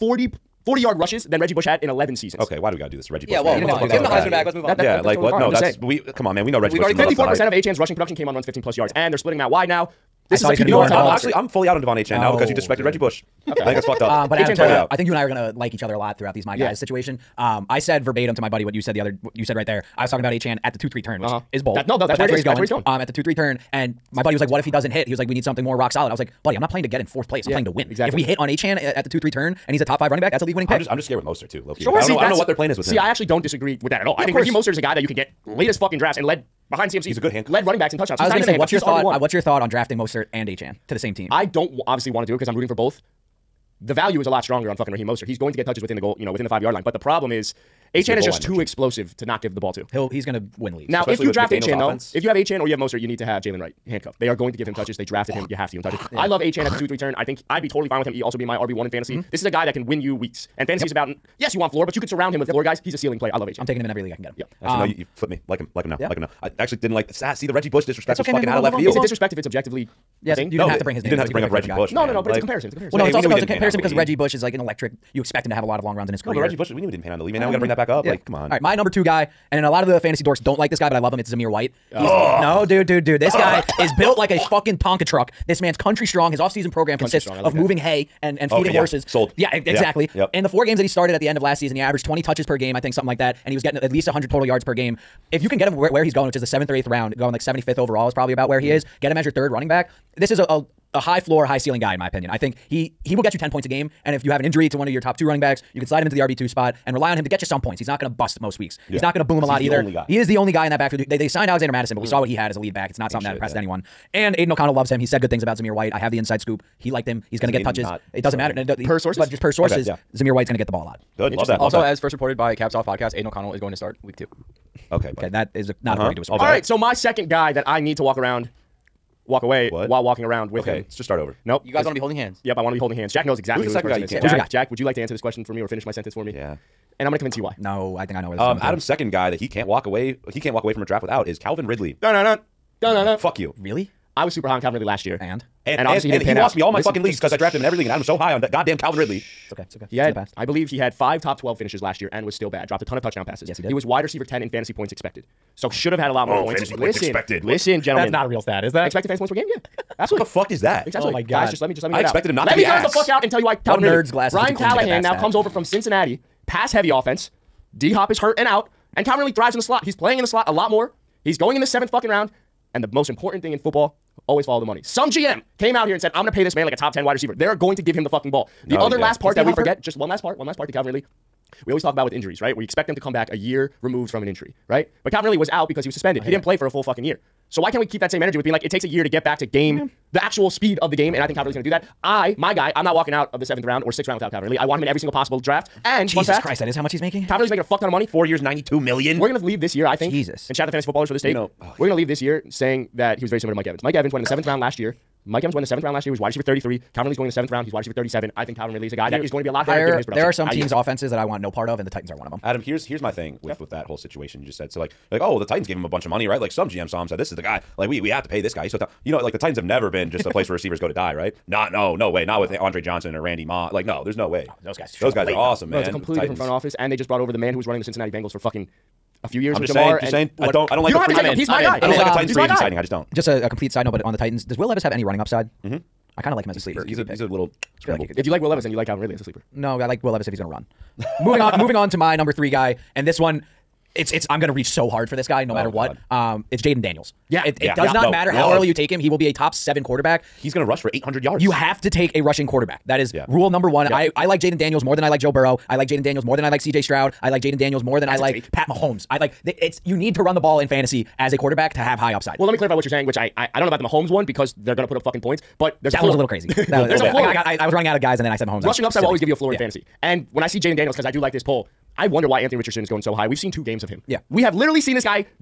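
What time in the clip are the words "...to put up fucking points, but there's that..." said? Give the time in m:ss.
4:24.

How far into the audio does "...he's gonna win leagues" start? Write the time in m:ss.
0:50.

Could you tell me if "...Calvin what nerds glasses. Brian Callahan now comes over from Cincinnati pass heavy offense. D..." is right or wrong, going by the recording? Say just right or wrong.
right.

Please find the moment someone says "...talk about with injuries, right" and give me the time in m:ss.
3:01.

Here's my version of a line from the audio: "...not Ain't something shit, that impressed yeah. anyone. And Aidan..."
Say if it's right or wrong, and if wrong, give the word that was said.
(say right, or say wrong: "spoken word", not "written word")
right.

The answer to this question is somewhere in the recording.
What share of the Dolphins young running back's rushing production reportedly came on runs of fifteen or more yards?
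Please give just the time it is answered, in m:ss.
0:06.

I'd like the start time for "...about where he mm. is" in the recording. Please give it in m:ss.
1:38.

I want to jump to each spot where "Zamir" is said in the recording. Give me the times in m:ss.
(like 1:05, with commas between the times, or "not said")
1:21, 1:55, 2:00.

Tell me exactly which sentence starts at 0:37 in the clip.
He's a good hand led running backs and touchdowns.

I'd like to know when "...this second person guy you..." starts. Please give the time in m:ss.
2:13.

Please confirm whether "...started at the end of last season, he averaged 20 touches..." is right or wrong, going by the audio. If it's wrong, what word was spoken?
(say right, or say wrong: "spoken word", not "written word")
right.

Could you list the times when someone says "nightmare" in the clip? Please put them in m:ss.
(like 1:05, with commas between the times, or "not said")
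not said.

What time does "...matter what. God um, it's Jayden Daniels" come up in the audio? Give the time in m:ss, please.
4:05.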